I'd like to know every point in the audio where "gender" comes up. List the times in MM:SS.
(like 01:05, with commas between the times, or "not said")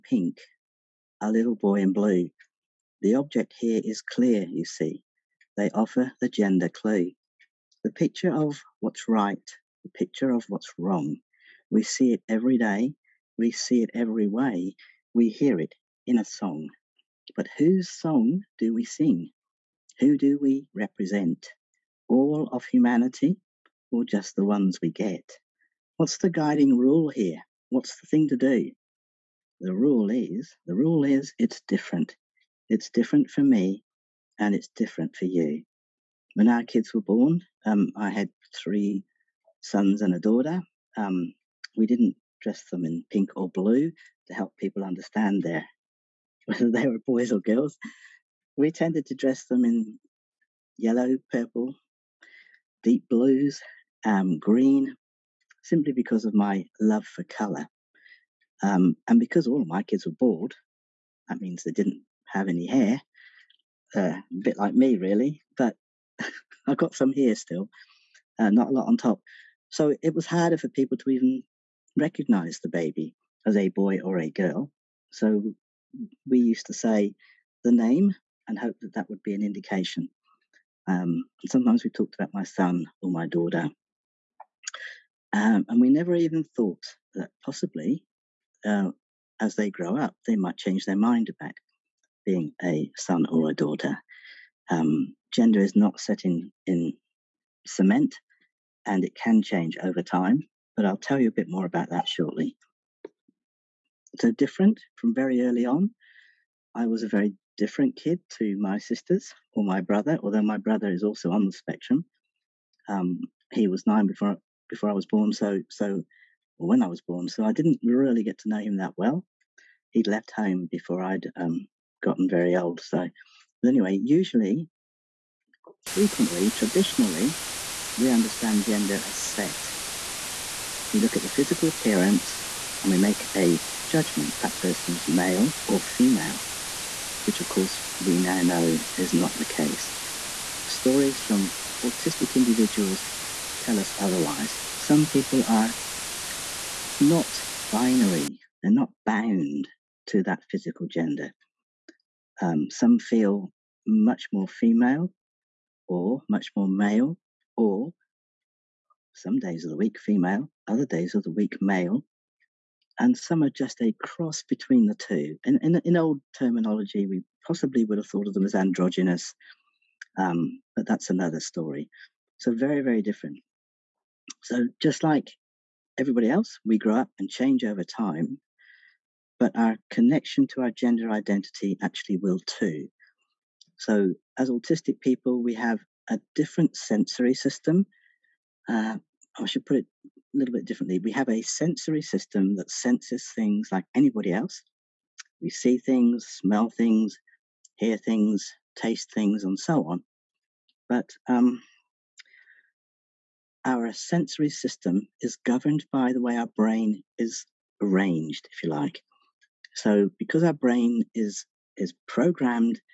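00:06, 01:35, 02:08, 02:30, 03:00.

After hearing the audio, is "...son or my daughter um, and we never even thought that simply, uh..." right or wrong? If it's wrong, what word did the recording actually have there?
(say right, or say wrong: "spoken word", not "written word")
wrong: "possibly", not "simply".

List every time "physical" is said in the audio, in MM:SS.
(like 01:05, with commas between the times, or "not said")
02:11, 02:30.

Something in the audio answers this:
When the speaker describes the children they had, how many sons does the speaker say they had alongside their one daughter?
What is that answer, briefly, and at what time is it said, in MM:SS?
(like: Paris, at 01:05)
3, at 00:38.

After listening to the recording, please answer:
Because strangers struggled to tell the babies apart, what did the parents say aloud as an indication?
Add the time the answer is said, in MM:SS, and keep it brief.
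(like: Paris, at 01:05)
The name, at 01:17.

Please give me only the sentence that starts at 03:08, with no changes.
Uh, I should put it a little bit differently.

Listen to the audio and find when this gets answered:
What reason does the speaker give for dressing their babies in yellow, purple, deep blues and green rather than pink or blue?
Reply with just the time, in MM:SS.
00:56.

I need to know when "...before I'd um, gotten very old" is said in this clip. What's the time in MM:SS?
02:00.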